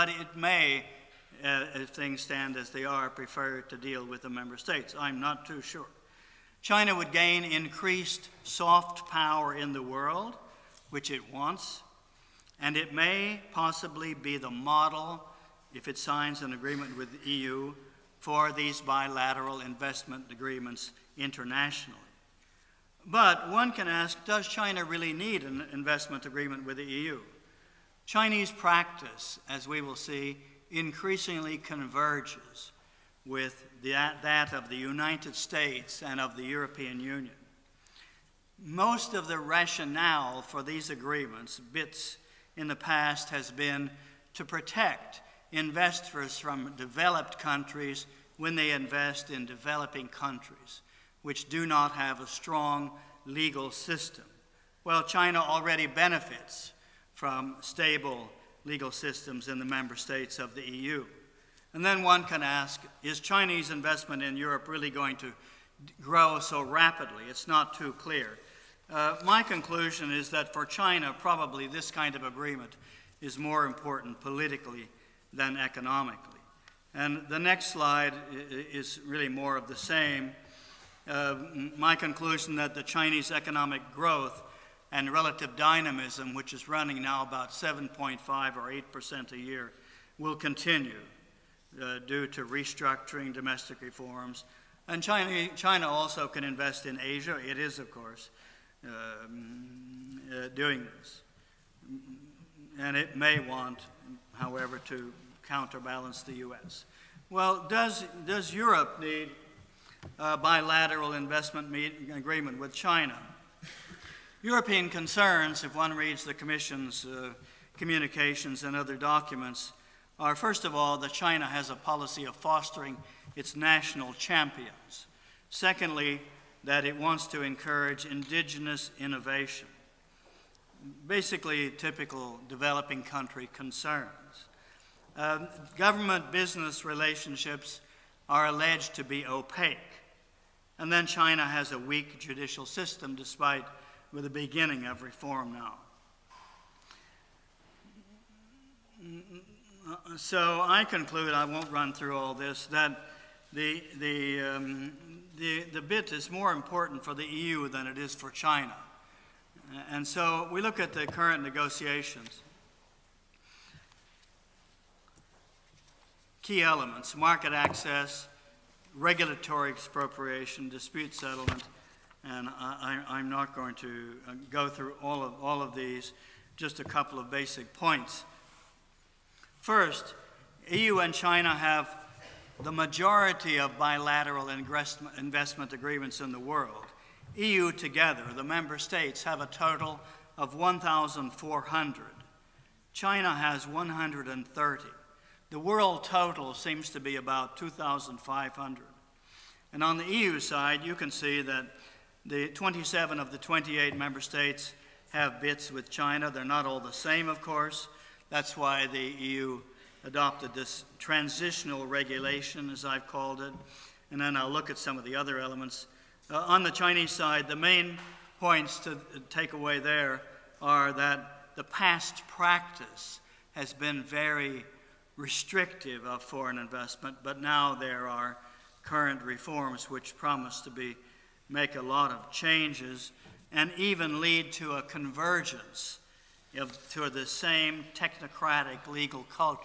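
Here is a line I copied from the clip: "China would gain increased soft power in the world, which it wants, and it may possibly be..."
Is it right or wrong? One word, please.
right.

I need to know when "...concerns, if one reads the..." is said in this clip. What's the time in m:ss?
1:54.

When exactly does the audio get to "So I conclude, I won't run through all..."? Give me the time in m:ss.
2:30.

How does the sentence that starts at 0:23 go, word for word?
But one can ask does China really need an investment agreement with the EU?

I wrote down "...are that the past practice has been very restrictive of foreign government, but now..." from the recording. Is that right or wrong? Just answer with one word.
wrong.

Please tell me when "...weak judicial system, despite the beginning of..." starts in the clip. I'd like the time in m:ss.
2:21.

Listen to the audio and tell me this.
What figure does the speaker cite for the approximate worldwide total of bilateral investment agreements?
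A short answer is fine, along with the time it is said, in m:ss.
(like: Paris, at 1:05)
2,500, at 3:17.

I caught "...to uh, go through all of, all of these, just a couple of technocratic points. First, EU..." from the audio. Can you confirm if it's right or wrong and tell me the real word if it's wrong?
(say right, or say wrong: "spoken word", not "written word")
wrong: "basic", not "technocratic".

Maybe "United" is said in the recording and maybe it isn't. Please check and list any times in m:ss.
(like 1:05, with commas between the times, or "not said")
0:34.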